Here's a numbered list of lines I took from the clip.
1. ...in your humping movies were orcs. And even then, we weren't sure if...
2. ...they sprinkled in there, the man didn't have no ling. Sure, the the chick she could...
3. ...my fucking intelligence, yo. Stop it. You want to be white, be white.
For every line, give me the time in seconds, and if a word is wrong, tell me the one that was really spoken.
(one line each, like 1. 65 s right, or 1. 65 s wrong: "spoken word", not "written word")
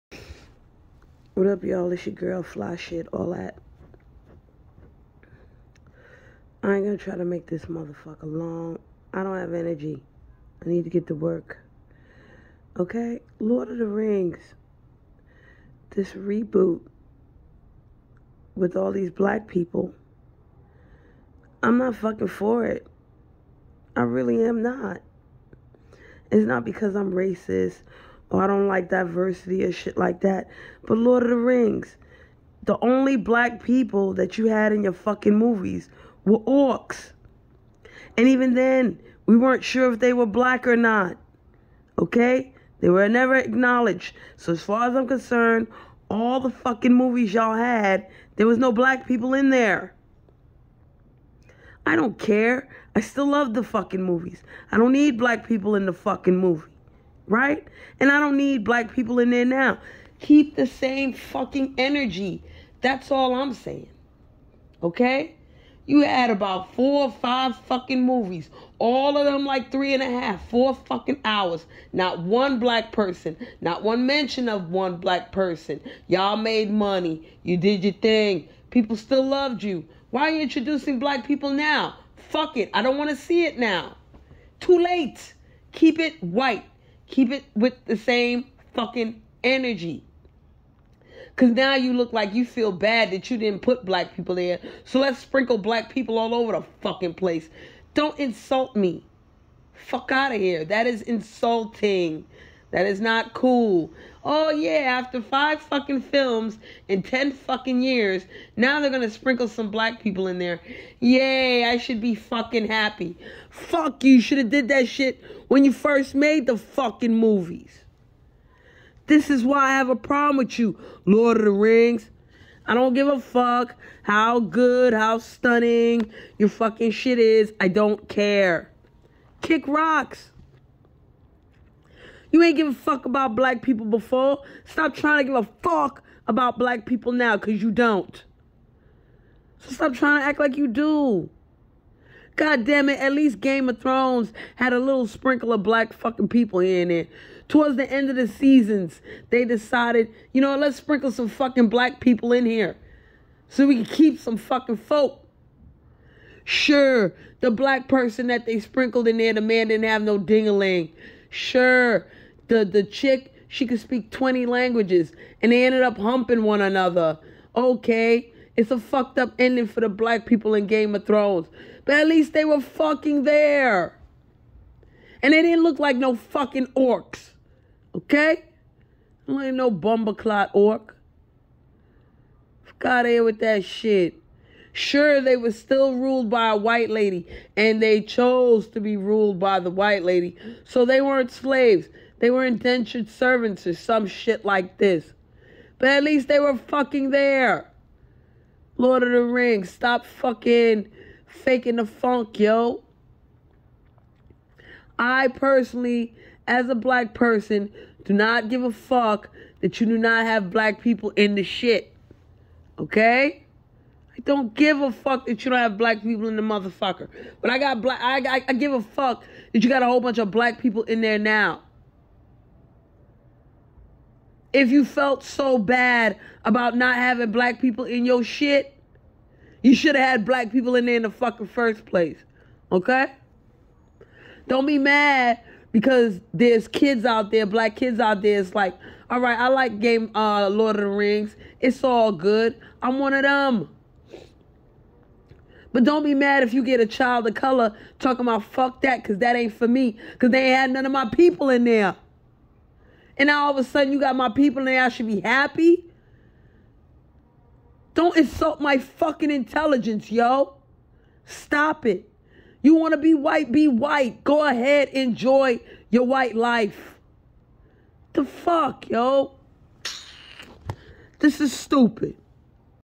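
1. 34 s wrong: "fucking", not "humping"
2. 158 s right
3. 258 s right.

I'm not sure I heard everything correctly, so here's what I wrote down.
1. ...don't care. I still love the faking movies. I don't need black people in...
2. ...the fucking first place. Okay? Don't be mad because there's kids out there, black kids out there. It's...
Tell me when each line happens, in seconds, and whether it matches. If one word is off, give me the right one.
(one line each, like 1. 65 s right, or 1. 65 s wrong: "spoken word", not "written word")
1. 51 s wrong: "fucking", not "faking"
2. 231 s right.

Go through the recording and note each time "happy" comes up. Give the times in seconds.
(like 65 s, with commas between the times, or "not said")
112 s, 255 s.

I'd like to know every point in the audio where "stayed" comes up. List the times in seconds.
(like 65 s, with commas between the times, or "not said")
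not said.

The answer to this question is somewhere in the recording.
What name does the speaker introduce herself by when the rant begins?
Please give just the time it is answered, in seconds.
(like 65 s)
2 s.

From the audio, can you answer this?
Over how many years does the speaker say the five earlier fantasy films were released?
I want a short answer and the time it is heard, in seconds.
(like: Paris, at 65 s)
10, at 107 s.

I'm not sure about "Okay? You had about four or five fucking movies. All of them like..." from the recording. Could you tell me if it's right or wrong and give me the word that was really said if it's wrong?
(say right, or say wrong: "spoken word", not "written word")
right.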